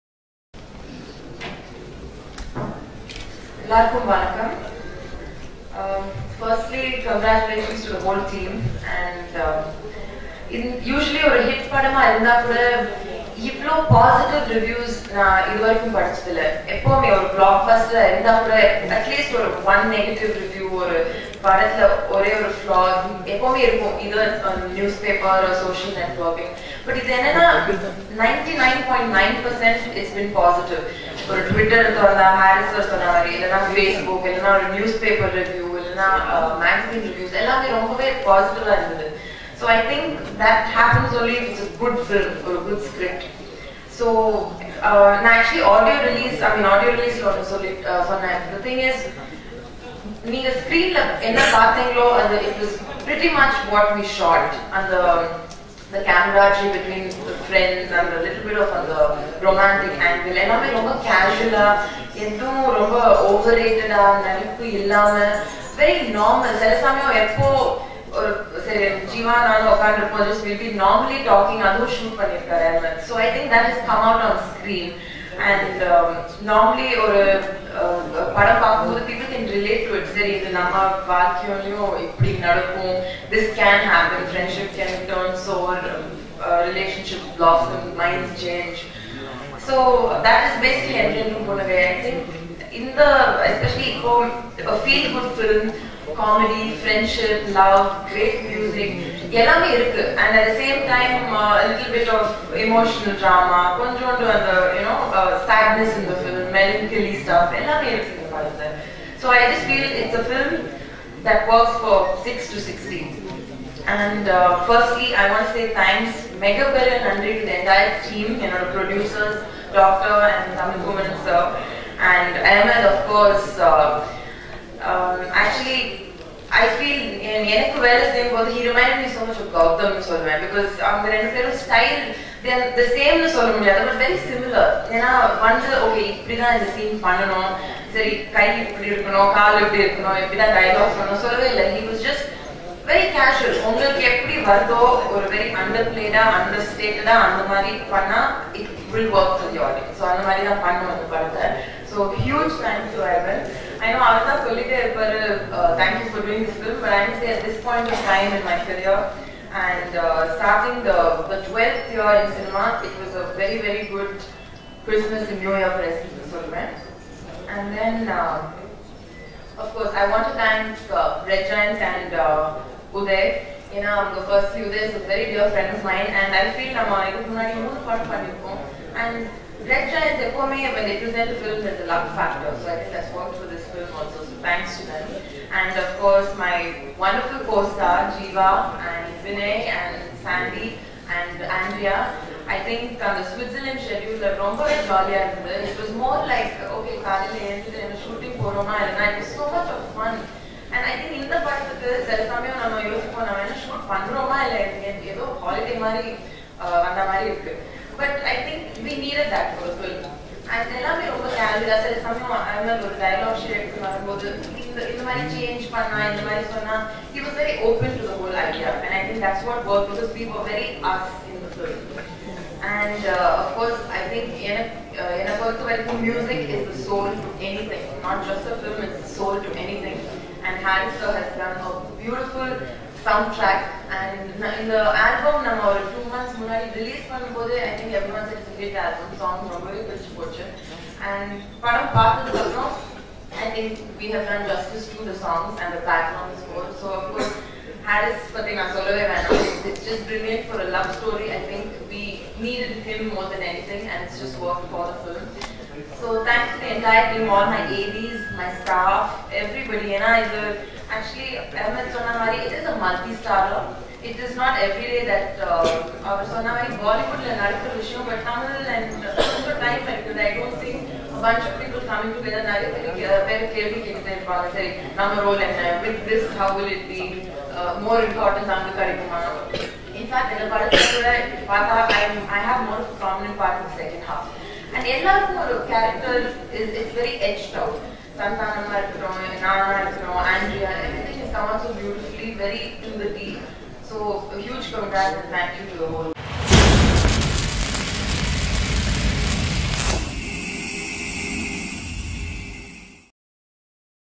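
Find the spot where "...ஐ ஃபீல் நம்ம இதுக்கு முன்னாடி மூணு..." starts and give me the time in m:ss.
2:56.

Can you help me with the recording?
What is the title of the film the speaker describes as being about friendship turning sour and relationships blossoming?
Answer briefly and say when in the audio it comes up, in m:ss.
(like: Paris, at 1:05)
Endrendrum Punnagai, at 1:31.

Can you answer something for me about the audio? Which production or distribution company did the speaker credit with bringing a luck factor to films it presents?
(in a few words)
Red Giant.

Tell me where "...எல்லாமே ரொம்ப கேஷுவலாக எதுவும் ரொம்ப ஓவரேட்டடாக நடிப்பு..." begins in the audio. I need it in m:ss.
1:00.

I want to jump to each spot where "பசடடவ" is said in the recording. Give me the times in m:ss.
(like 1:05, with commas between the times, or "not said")
0:13, 0:30, 0:38.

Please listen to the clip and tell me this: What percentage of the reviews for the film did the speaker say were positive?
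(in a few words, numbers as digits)
99.9%.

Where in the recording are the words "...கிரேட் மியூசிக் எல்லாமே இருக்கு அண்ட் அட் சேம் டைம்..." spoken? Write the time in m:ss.
1:38.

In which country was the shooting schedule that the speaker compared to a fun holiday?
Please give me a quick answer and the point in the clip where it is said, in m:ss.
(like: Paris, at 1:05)
Switzerland, at 3:13.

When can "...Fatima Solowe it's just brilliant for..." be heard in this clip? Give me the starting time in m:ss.
4:08.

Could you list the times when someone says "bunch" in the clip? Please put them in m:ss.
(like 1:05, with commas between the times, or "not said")
4:31.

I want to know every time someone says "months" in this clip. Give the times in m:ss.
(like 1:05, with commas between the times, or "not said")
3:56.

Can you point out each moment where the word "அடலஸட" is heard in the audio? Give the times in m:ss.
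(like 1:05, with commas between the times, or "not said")
0:18.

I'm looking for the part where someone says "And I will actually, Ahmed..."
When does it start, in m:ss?
4:19.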